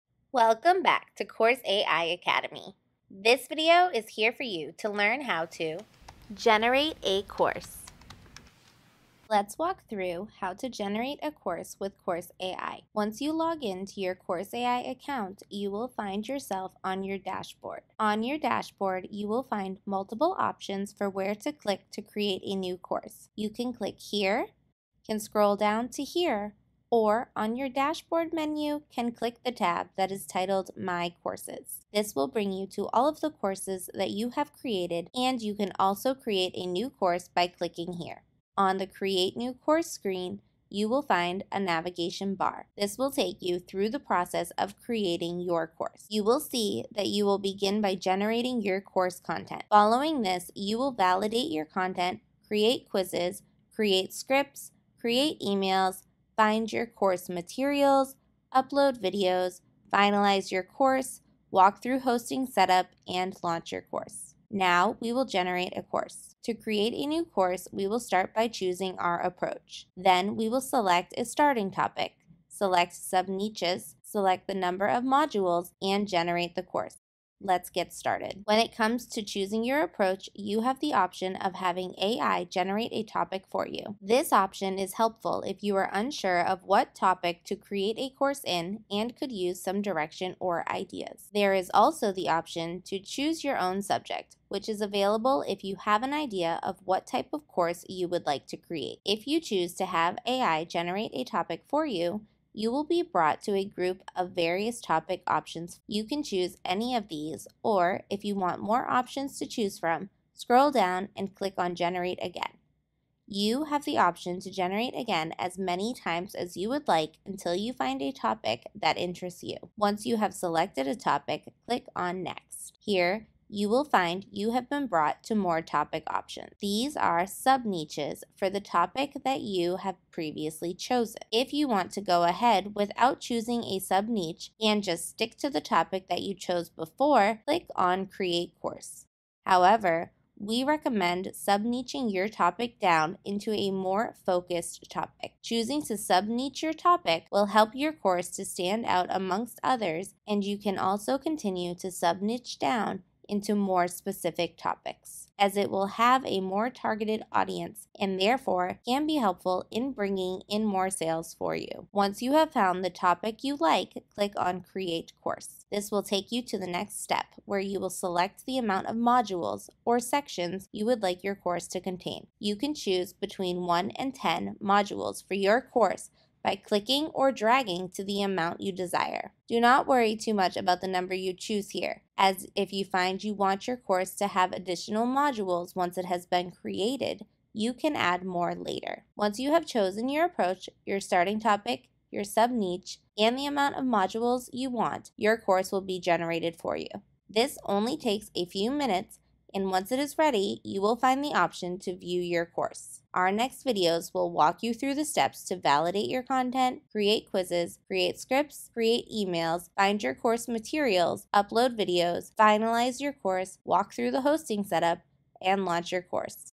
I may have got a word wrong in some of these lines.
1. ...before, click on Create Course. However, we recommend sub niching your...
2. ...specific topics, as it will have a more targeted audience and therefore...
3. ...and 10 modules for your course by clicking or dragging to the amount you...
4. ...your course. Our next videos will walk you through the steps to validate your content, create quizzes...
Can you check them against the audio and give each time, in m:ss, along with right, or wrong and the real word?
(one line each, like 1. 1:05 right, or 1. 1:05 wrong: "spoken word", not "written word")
1. 2:16 right
2. 2:33 right
3. 2:53 right
4. 3:22 right.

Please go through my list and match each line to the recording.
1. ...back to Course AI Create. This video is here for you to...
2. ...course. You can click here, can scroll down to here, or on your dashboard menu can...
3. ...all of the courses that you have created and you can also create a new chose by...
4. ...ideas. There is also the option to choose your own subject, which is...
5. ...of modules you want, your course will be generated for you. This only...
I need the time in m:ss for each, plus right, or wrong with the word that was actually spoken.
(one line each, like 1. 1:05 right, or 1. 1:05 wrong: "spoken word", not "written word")
1. 0:00 wrong: "Academy", not "Create"
2. 0:22 right
3. 0:32 wrong: "course", not "chose"
4. 1:30 right
5. 3:13 right.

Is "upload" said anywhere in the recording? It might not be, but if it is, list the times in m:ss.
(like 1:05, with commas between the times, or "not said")
0:58, 3:31.